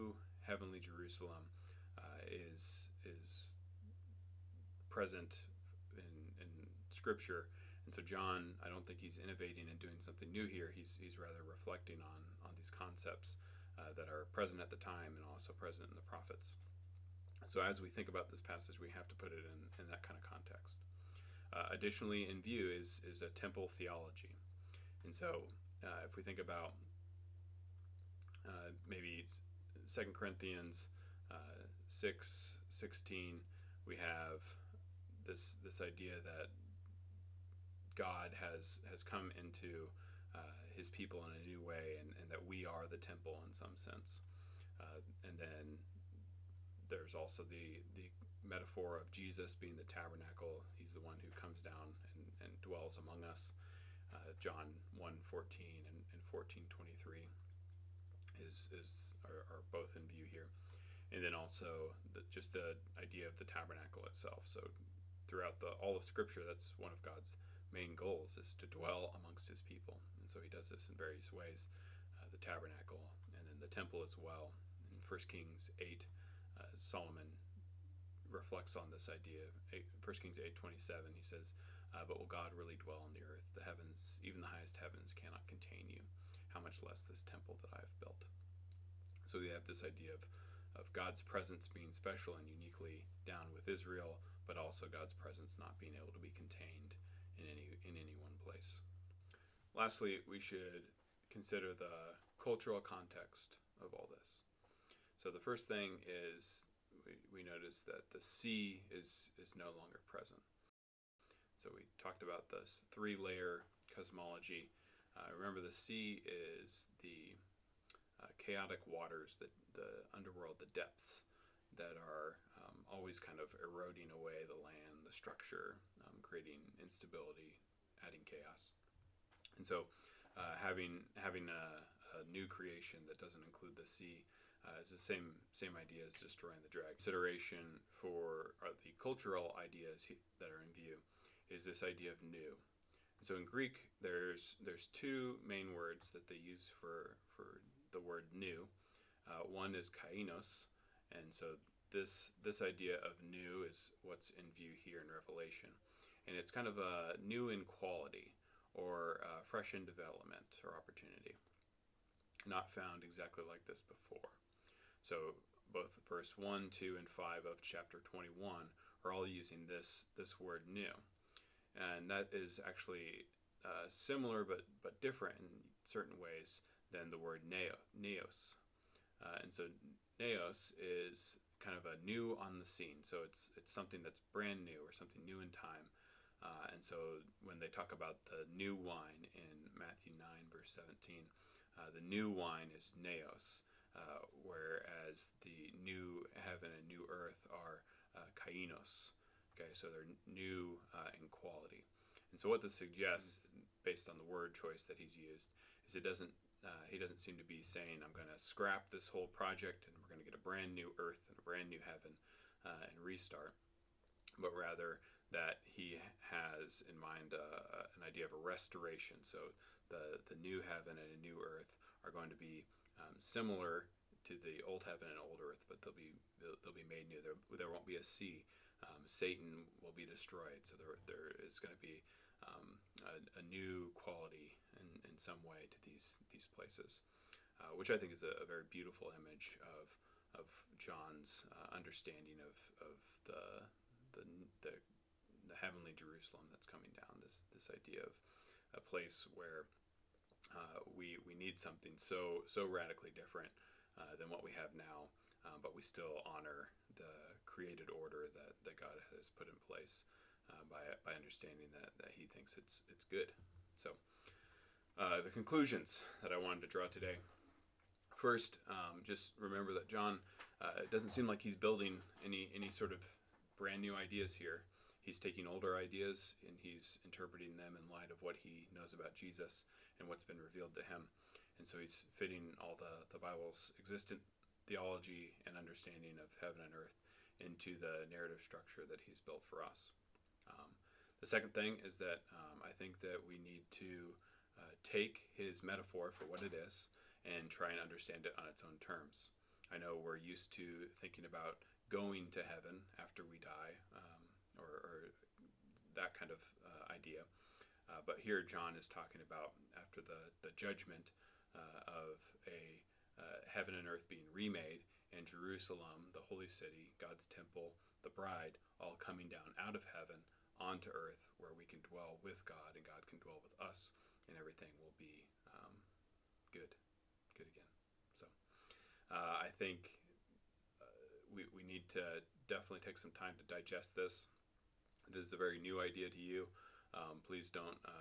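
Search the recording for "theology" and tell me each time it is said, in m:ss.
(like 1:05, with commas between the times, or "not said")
0:23, 4:44.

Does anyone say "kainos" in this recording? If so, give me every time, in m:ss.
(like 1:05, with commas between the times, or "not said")
2:29, 3:18.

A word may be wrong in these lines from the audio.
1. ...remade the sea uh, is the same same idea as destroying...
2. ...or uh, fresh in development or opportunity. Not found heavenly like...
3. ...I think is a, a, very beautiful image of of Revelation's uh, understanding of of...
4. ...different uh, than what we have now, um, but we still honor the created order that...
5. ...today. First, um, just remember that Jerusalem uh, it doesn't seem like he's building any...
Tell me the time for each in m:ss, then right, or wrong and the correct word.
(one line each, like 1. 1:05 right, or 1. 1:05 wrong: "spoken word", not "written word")
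1. 2:13 wrong: "include", not "remade"
2. 2:38 wrong: "exactly", not "heavenly"
3. 3:57 wrong: "John", not "Revelation"
4. 4:13 right
5. 4:26 wrong: "John", not "Jerusalem".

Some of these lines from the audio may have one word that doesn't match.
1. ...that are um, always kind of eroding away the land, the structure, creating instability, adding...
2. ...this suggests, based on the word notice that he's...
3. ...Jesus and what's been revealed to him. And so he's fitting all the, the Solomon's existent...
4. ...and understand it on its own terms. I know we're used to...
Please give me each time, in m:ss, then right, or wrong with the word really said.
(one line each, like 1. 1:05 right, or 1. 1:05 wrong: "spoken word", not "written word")
1. 2:01 right
2. 3:22 wrong: "choice", not "notice"
3. 4:39 wrong: "Bible", not "Solomon"
4. 4:57 right.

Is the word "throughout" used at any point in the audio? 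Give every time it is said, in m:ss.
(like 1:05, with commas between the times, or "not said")
1:05.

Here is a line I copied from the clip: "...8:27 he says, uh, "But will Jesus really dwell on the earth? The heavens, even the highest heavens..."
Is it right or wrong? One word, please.
wrong.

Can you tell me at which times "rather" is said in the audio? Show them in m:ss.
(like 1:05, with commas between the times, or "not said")
0:11, 3:34.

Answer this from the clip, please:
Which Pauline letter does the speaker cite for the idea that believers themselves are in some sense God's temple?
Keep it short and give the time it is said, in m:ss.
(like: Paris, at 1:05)
2 Corinthians, at 0:29.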